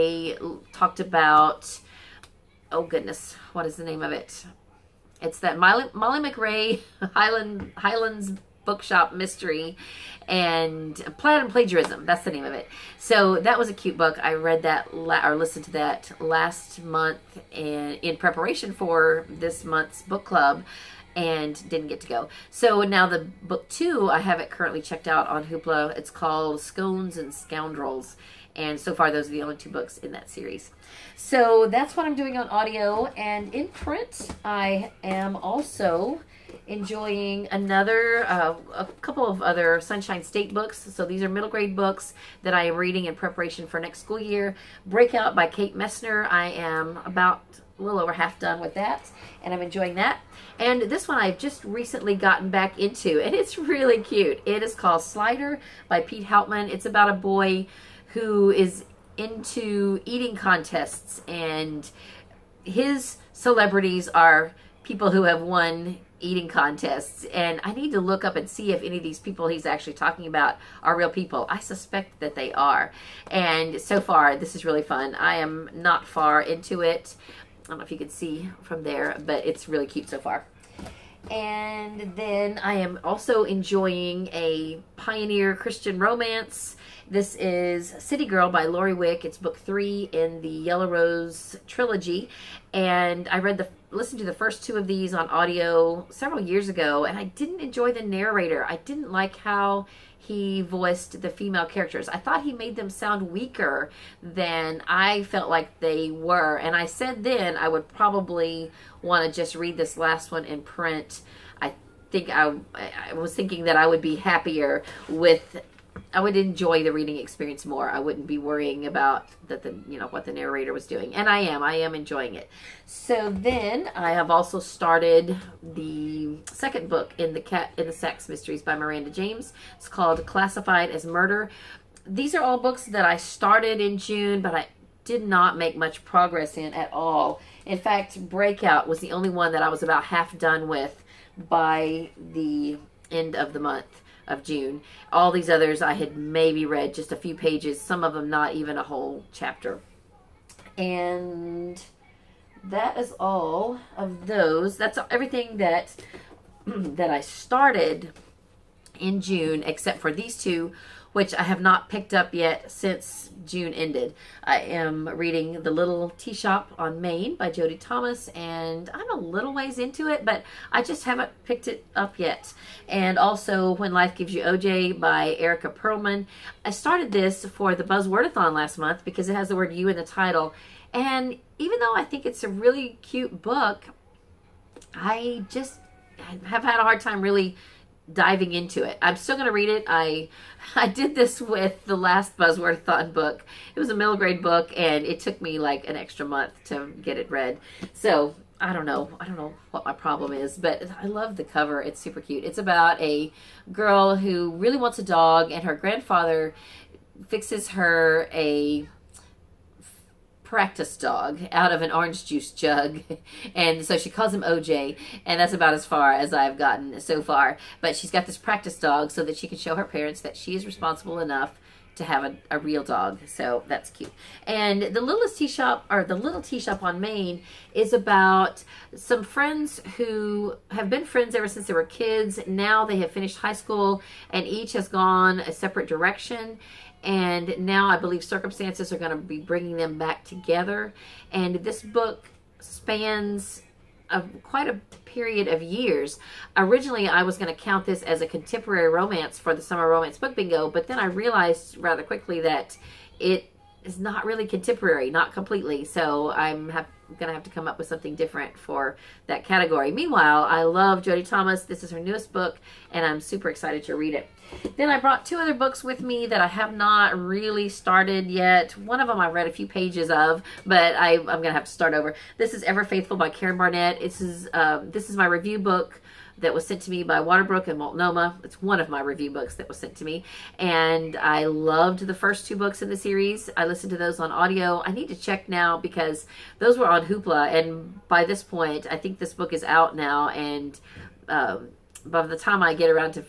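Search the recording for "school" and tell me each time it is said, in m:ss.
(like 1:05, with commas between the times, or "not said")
0:44, 3:53.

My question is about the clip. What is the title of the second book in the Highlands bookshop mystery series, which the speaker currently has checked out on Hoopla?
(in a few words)
Scones and Scoundrels.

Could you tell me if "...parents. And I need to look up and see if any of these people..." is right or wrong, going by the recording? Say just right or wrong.
wrong.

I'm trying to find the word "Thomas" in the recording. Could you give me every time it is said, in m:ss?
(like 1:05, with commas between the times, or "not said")
2:47, 4:21.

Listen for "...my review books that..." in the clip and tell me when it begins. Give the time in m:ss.
4:38.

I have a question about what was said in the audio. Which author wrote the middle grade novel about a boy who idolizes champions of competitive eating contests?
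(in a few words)
Pete Hautman.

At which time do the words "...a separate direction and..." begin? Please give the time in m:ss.
3:55.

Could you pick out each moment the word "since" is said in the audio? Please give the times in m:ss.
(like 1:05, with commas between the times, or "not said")
2:42, 3:51.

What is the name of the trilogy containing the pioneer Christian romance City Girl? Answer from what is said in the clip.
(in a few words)
Yellow Rose.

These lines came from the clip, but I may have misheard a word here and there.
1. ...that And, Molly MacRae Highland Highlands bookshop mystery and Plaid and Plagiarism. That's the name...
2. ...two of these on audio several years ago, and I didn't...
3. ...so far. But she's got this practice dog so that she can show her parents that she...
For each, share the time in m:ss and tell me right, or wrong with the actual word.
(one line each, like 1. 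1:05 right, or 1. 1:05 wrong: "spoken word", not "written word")
1. 0:05 wrong: "Molly", not "And"
2. 1:34 right
3. 3:37 right.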